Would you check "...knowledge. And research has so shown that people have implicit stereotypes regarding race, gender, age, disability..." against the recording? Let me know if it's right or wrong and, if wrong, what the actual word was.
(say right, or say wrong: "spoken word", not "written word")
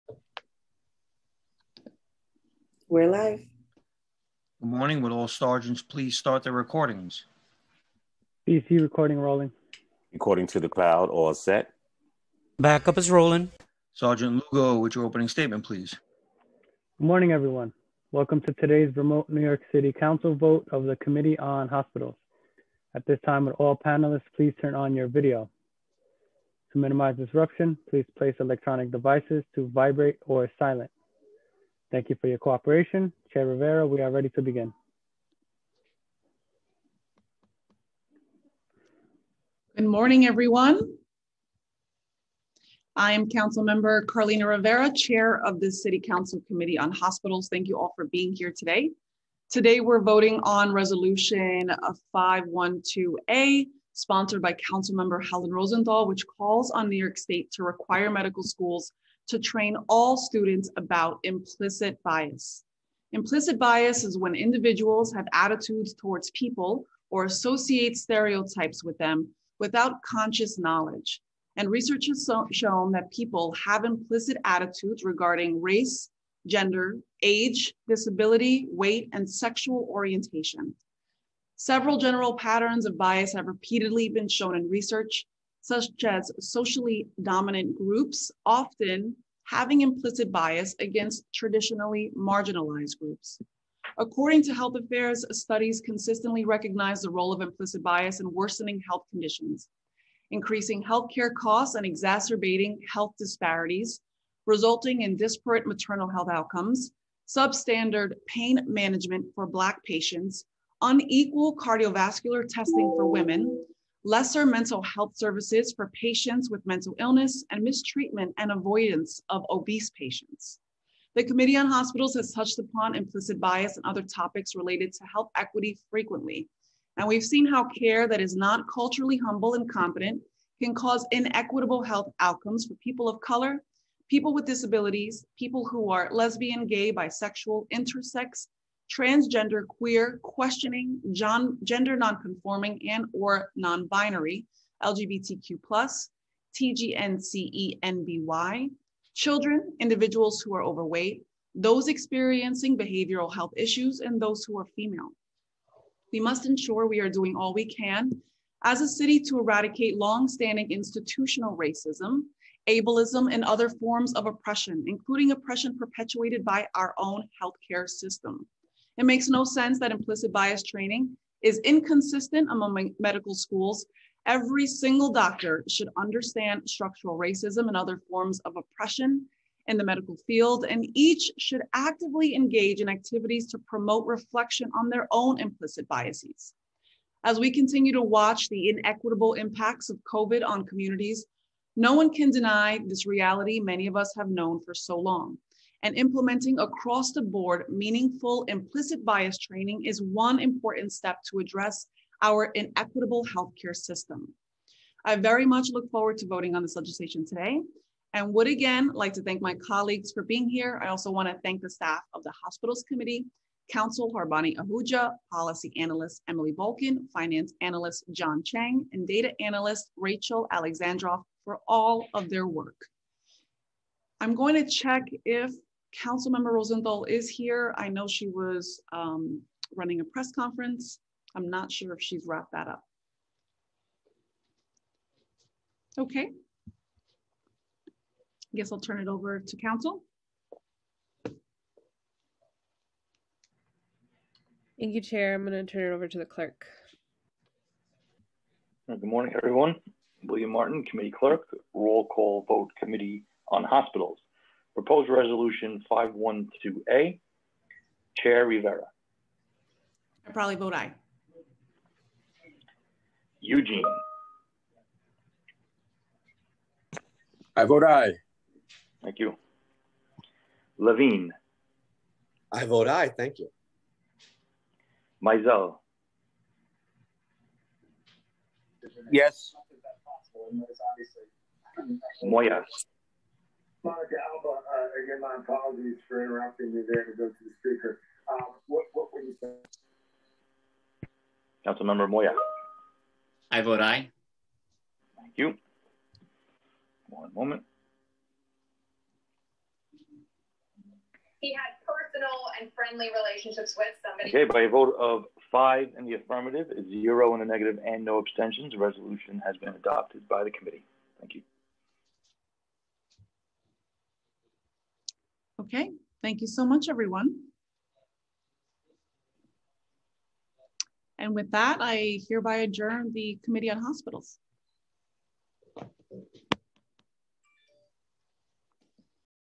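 wrong: "attitudes", not "stereotypes".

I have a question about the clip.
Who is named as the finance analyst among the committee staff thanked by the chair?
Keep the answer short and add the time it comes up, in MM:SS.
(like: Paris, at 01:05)
John Chang, at 03:38.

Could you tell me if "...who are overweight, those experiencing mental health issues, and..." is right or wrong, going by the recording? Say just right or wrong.
wrong.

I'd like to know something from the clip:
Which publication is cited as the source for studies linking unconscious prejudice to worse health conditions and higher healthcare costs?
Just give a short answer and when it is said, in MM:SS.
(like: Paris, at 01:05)
Health Affairs, at 01:34.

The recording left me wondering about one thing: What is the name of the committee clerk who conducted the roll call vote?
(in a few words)
William Martin.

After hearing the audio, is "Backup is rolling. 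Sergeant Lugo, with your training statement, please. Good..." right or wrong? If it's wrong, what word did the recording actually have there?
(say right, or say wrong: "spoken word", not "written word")
wrong: "opening", not "training".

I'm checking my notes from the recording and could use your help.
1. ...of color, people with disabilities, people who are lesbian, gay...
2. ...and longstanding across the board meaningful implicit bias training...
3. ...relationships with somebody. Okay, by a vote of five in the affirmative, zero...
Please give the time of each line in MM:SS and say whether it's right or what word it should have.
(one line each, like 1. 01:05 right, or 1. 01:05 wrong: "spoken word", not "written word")
1. 02:13 right
2. 03:15 wrong: "implementing", not "longstanding"
3. 05:03 right.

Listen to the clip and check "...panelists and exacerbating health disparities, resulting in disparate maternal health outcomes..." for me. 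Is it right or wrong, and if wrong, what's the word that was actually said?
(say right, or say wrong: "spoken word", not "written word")
wrong: "costs", not "panelists".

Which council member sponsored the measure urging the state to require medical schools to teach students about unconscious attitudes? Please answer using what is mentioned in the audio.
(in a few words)
Helen Rosenthal.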